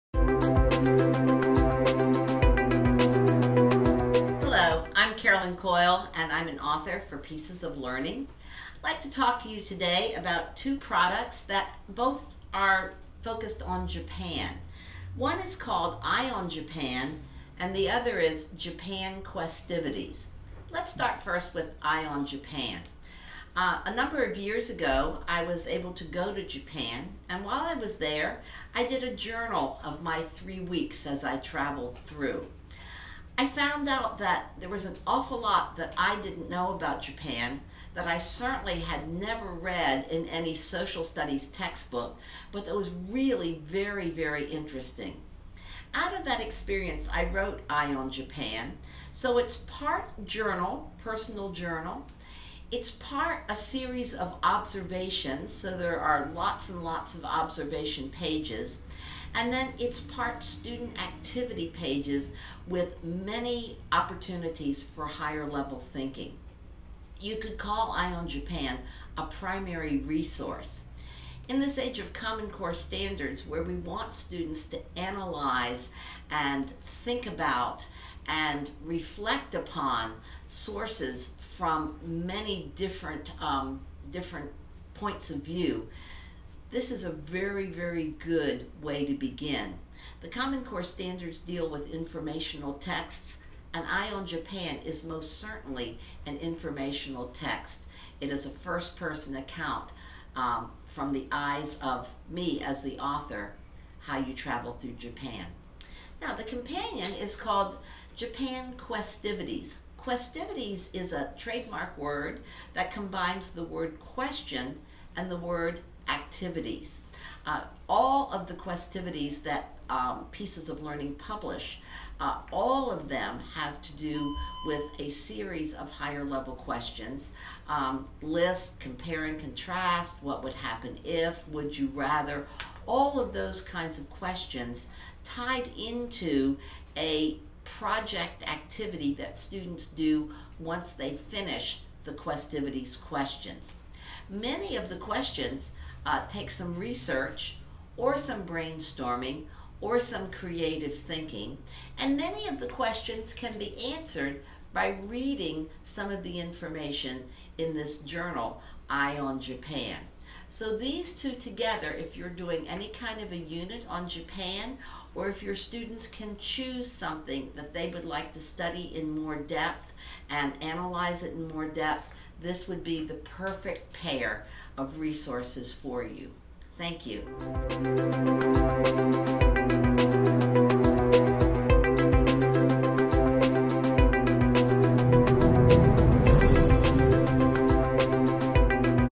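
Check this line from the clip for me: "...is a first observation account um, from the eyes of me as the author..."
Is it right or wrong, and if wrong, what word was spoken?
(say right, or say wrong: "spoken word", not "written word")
wrong: "person", not "observation".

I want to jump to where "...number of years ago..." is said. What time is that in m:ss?
0:23.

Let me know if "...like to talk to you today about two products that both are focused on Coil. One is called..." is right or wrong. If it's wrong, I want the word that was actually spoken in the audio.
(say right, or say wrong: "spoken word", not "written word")
wrong: "Japan", not "Coil".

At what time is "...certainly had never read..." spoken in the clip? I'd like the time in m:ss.
0:38.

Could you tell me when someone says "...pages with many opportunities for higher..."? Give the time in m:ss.
1:01.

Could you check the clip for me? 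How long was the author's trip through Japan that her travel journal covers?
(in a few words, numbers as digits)
3 weeks.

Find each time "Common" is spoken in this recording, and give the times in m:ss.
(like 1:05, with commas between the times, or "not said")
1:12, 1:30.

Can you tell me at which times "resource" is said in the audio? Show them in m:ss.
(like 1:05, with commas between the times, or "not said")
1:09, 2:54.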